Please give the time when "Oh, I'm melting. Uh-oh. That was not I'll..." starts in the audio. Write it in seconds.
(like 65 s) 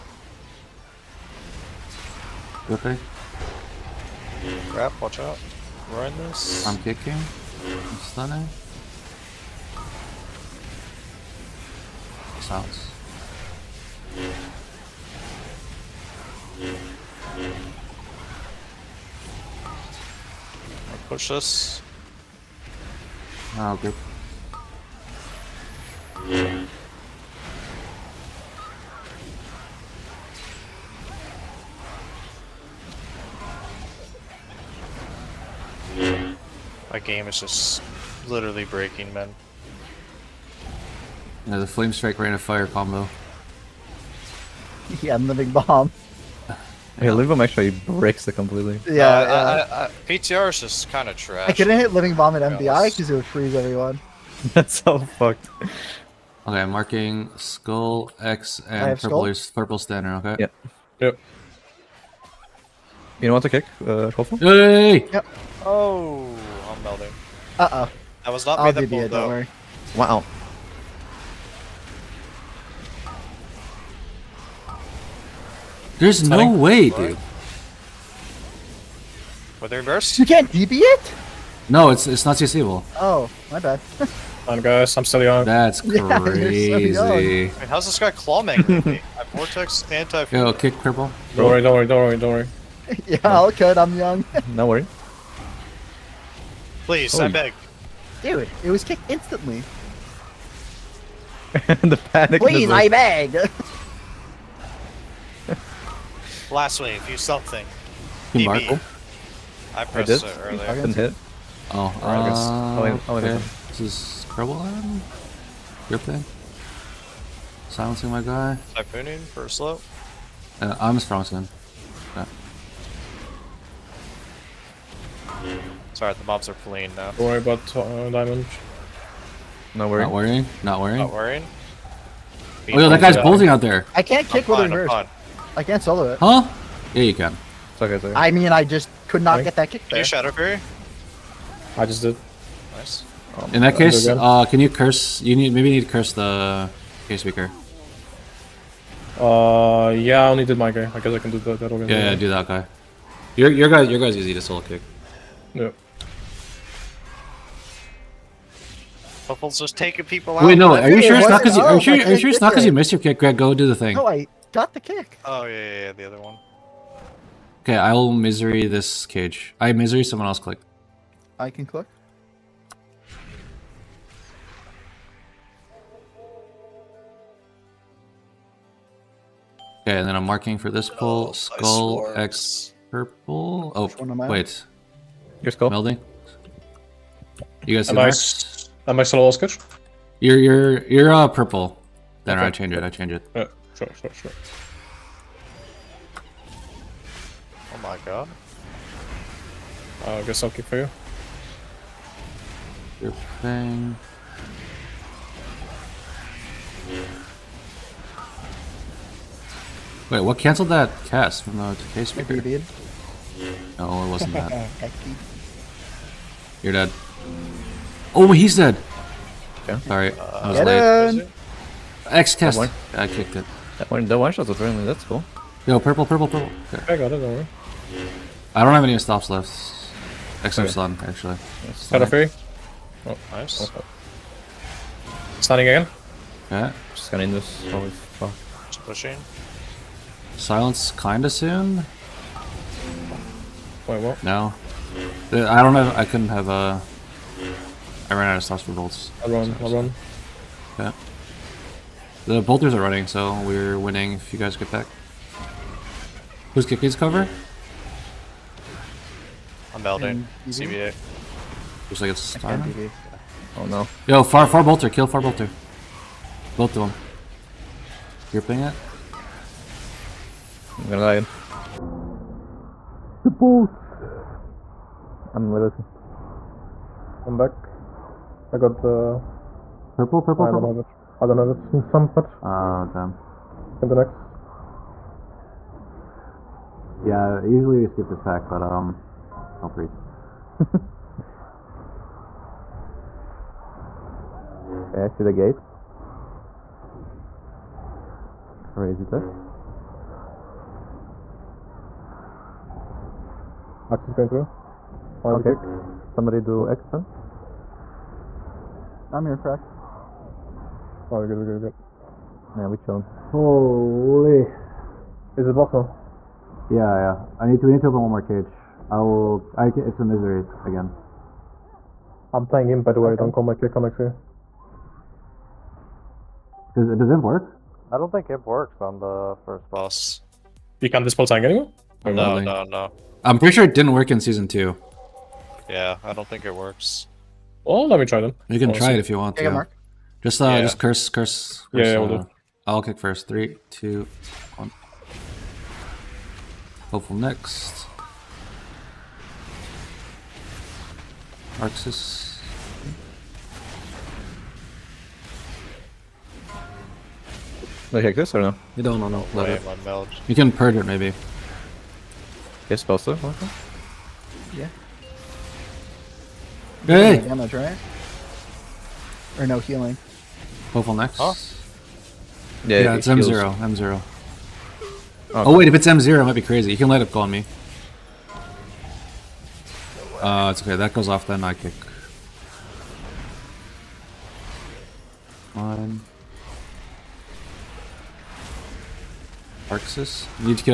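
65 s.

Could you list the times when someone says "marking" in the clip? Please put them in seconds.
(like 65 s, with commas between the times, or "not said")
56 s, 180 s.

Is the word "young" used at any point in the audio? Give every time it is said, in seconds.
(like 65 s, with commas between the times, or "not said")
85 s, 93 s.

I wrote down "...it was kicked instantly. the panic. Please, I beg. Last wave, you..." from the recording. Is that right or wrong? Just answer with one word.
right.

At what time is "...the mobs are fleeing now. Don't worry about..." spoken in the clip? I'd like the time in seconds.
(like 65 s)
126 s.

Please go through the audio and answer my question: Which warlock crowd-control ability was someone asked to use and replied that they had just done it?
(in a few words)
Shadowfury.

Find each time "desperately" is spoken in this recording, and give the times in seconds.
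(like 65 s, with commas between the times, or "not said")
not said.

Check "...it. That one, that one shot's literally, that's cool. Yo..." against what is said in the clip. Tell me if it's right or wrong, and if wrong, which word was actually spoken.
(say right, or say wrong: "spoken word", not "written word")
wrong: "apparently", not "literally".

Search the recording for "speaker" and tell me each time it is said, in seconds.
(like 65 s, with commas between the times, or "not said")
147 s, 212 s.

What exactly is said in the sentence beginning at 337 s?
Well, oh, let me try them.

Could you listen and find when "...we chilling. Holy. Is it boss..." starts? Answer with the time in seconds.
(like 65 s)
312 s.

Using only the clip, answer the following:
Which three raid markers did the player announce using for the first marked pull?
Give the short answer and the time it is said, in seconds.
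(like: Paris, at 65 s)
Skull, X, purple, at 57 s.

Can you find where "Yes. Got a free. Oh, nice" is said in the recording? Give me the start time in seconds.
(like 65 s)
231 s.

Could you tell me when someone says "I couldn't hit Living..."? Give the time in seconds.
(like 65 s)
51 s.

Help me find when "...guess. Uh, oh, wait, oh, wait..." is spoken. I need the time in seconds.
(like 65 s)
112 s.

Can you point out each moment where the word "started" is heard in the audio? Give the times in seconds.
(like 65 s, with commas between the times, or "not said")
not said.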